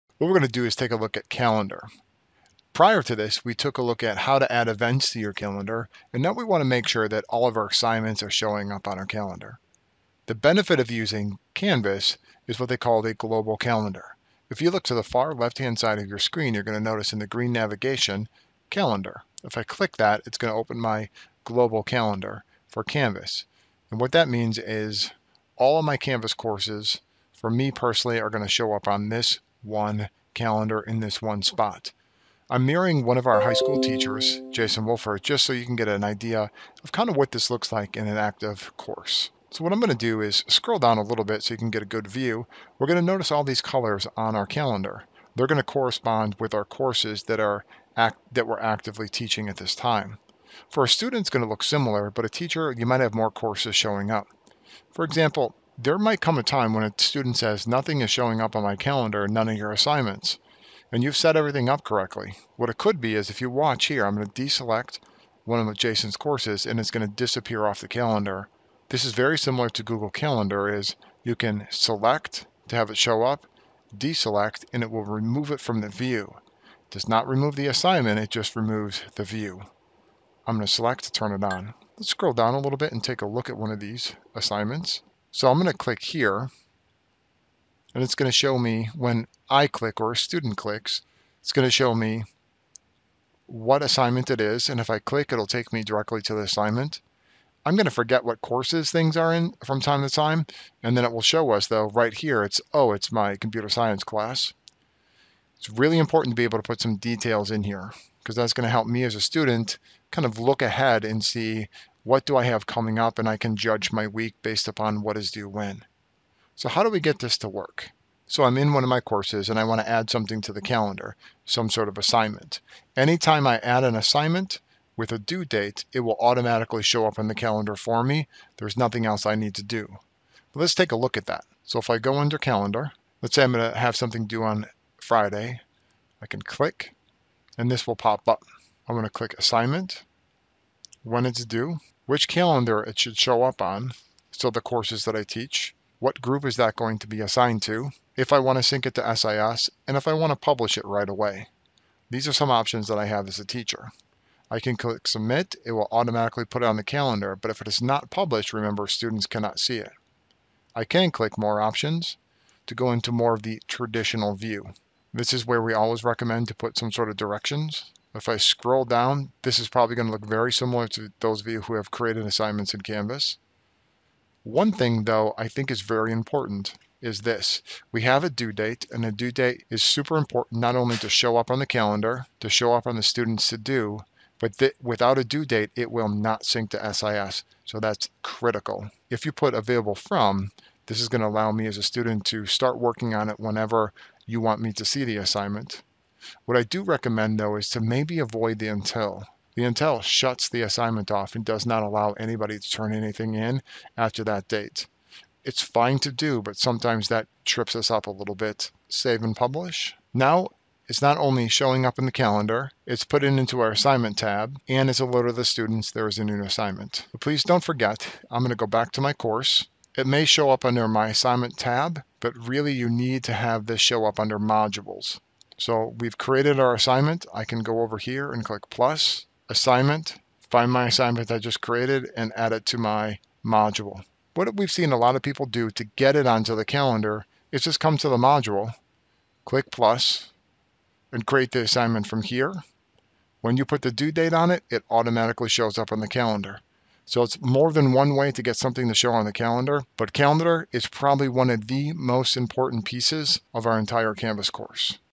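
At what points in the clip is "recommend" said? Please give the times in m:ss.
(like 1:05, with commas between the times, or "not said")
2:46, 3:16.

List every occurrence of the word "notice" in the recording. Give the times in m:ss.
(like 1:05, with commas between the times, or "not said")
0:16, 0:43.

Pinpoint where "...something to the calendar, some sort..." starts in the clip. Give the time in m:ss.
2:00.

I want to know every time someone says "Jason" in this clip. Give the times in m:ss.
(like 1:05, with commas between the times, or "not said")
0:34, 1:05.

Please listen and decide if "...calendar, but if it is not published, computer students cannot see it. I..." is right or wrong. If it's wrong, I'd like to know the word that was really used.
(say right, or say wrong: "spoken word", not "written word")
wrong: "remember", not "computer".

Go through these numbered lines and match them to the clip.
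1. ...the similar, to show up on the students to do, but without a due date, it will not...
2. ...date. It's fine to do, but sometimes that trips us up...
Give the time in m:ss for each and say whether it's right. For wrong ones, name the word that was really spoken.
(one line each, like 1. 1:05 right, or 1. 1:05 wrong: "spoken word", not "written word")
1. 3:01 wrong: "calendar", not "similar"
2. 3:24 right.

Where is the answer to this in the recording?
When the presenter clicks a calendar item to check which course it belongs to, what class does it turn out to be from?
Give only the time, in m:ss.
1:43.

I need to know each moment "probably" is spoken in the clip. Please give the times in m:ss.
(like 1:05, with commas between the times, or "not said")
2:49, 4:10.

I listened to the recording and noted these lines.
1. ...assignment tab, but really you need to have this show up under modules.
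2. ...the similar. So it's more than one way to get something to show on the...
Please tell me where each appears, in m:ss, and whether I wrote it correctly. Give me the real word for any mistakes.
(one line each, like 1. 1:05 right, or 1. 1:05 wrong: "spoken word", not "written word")
1. 3:41 right
2. 4:05 wrong: "calendar", not "similar".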